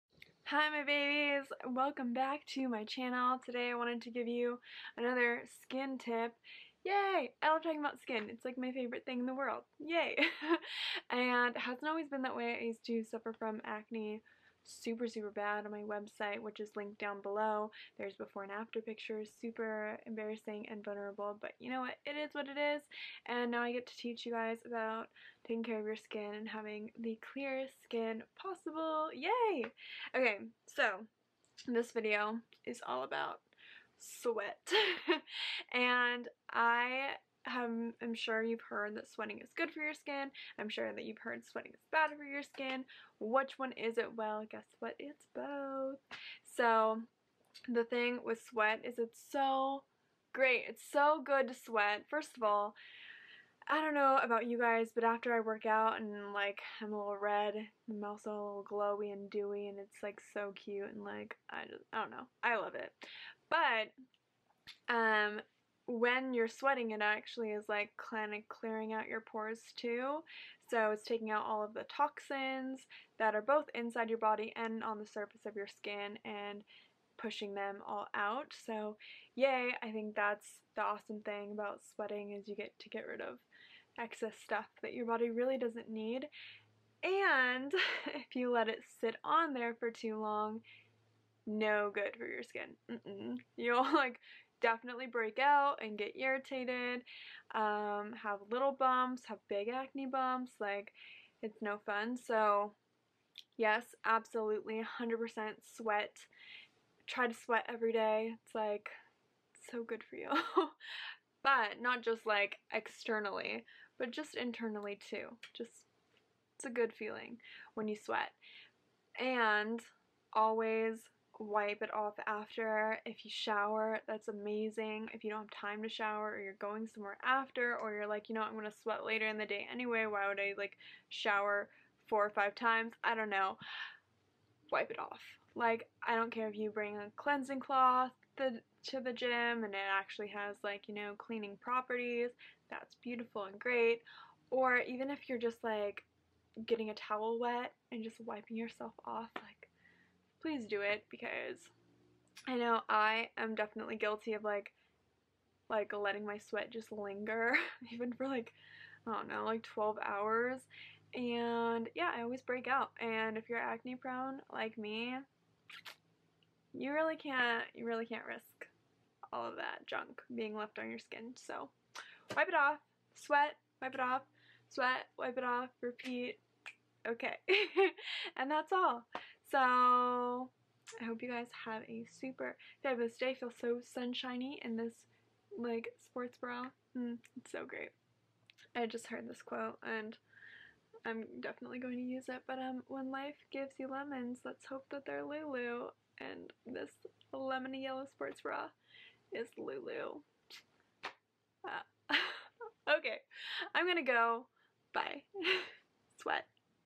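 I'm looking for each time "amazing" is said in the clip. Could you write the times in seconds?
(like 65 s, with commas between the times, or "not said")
124 s.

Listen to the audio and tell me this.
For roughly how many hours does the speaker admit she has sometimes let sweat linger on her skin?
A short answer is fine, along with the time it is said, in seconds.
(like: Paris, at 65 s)
12, at 159 s.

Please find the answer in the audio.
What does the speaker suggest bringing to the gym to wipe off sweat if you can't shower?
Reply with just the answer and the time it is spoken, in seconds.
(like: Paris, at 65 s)
cleansing cloth, at 137 s.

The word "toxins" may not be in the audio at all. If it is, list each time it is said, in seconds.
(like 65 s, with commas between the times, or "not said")
71 s.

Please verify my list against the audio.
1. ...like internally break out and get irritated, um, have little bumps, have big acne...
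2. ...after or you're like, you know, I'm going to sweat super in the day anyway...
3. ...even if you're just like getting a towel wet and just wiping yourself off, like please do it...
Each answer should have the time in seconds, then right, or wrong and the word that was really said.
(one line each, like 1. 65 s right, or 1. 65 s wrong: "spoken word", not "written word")
1. 93 s wrong: "definitely", not "internally"
2. 127 s wrong: "later", not "super"
3. 144 s right.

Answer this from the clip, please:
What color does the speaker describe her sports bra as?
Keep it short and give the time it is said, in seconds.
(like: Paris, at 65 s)
lemony yellow, at 197 s.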